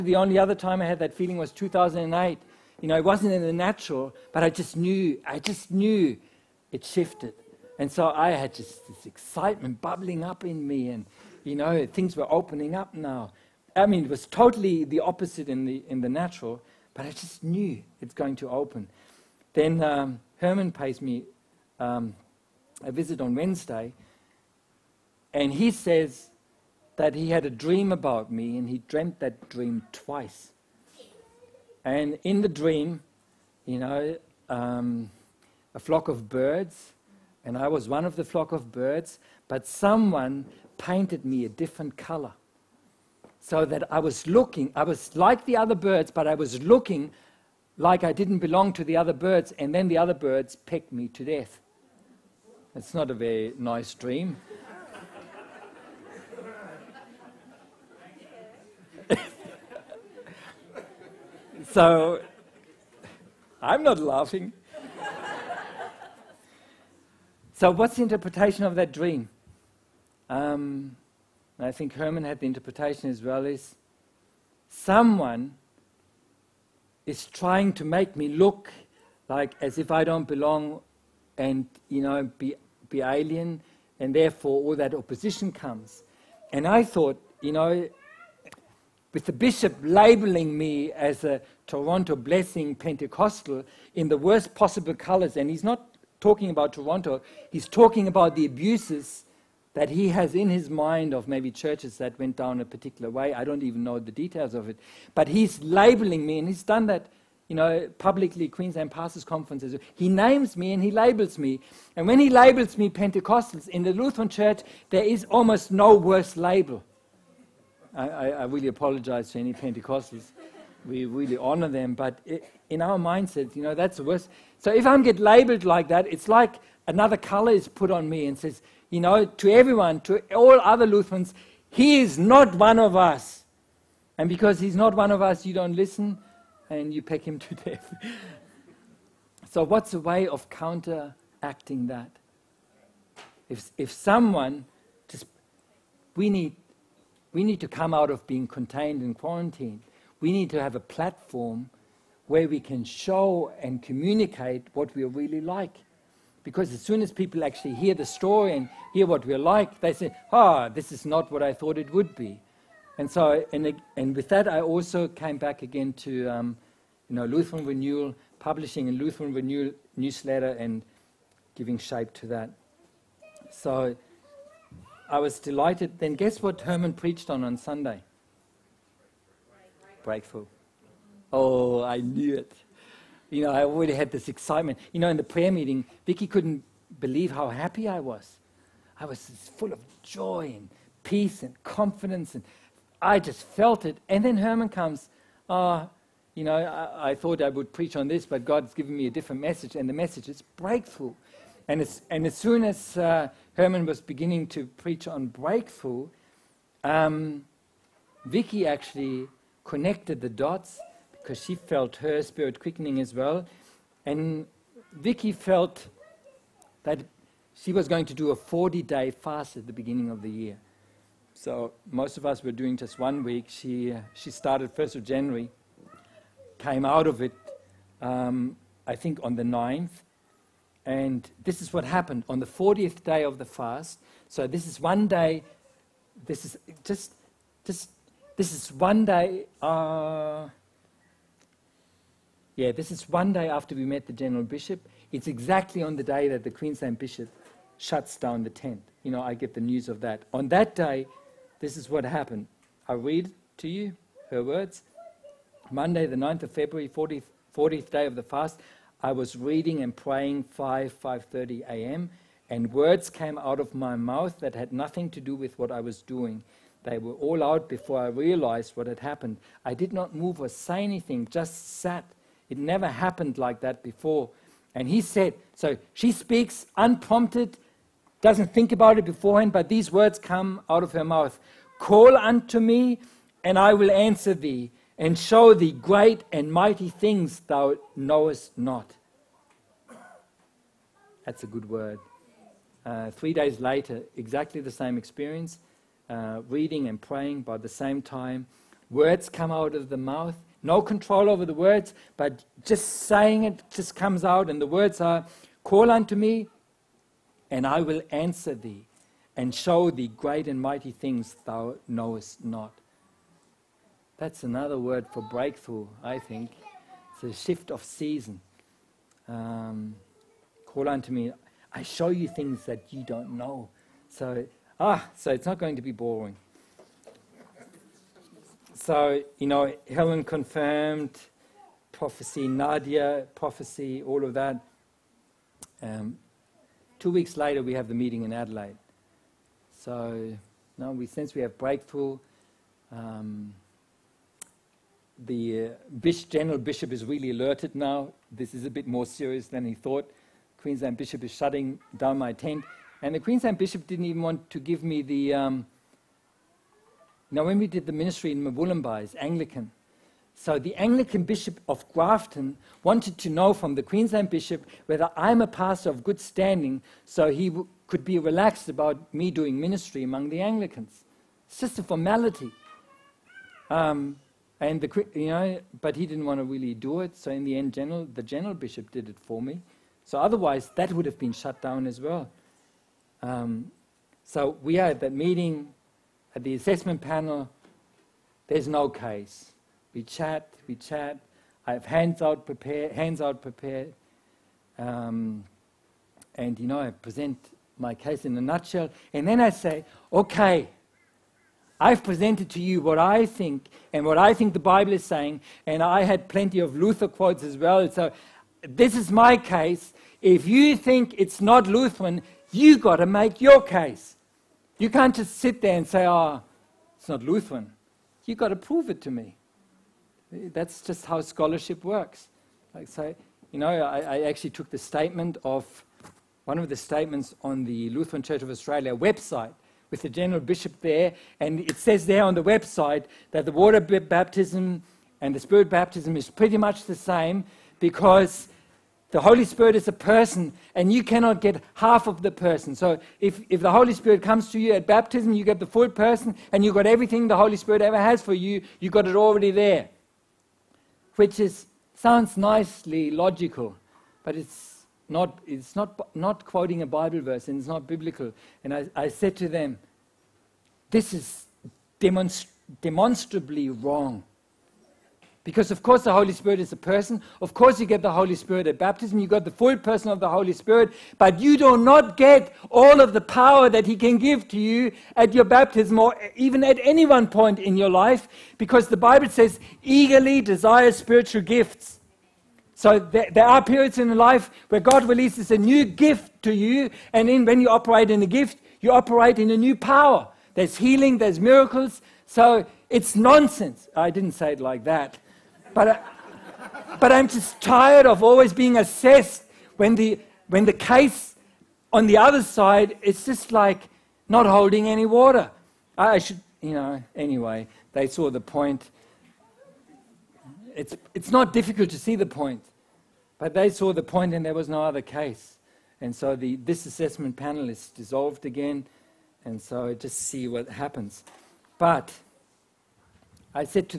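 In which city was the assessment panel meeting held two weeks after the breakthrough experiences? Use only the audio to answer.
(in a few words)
Adelaide.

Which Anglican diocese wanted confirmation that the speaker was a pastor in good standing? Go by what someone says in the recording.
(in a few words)
Grafton.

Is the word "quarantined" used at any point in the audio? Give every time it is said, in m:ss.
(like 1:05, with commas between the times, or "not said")
2:29.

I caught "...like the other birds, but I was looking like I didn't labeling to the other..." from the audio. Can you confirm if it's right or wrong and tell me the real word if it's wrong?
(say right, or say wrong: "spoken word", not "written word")
wrong: "belong", not "labeling".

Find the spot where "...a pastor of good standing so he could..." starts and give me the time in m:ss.
6:05.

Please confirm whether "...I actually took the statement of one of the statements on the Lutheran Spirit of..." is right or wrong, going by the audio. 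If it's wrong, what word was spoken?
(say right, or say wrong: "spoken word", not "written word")
wrong: "Church", not "Spirit".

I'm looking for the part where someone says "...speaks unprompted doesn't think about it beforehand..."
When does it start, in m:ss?
4:36.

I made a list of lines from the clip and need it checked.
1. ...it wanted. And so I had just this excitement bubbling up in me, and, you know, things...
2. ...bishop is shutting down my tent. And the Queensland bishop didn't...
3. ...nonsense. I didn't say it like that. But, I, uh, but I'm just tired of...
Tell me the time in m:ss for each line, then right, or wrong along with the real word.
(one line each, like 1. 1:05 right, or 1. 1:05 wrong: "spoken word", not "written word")
1. 0:06 wrong: "shifted", not "wanted"
2. 5:50 right
3. 8:13 right.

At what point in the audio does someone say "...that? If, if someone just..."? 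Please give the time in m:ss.
2:21.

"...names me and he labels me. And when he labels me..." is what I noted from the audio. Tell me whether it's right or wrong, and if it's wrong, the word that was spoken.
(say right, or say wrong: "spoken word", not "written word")
right.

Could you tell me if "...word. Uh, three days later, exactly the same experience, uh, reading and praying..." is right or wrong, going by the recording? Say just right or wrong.
right.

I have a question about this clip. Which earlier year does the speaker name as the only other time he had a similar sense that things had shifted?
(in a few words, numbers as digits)
2008.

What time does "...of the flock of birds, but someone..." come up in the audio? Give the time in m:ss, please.
0:38.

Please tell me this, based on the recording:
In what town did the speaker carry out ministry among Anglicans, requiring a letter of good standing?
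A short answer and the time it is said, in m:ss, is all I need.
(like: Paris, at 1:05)
Mullumbimby, at 5:58.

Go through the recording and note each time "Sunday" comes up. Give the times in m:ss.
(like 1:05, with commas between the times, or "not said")
2:57.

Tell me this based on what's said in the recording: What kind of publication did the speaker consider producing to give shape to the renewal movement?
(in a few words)
Newsletter.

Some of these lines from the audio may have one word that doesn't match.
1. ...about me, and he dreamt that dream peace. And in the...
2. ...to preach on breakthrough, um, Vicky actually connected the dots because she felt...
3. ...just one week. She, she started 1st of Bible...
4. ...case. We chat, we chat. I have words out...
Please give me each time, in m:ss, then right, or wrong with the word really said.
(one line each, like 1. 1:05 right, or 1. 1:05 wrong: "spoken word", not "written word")
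1. 0:27 wrong: "twice", not "peace"
2. 3:24 right
3. 3:42 wrong: "January", not "Bible"
4. 6:28 wrong: "hands", not "words".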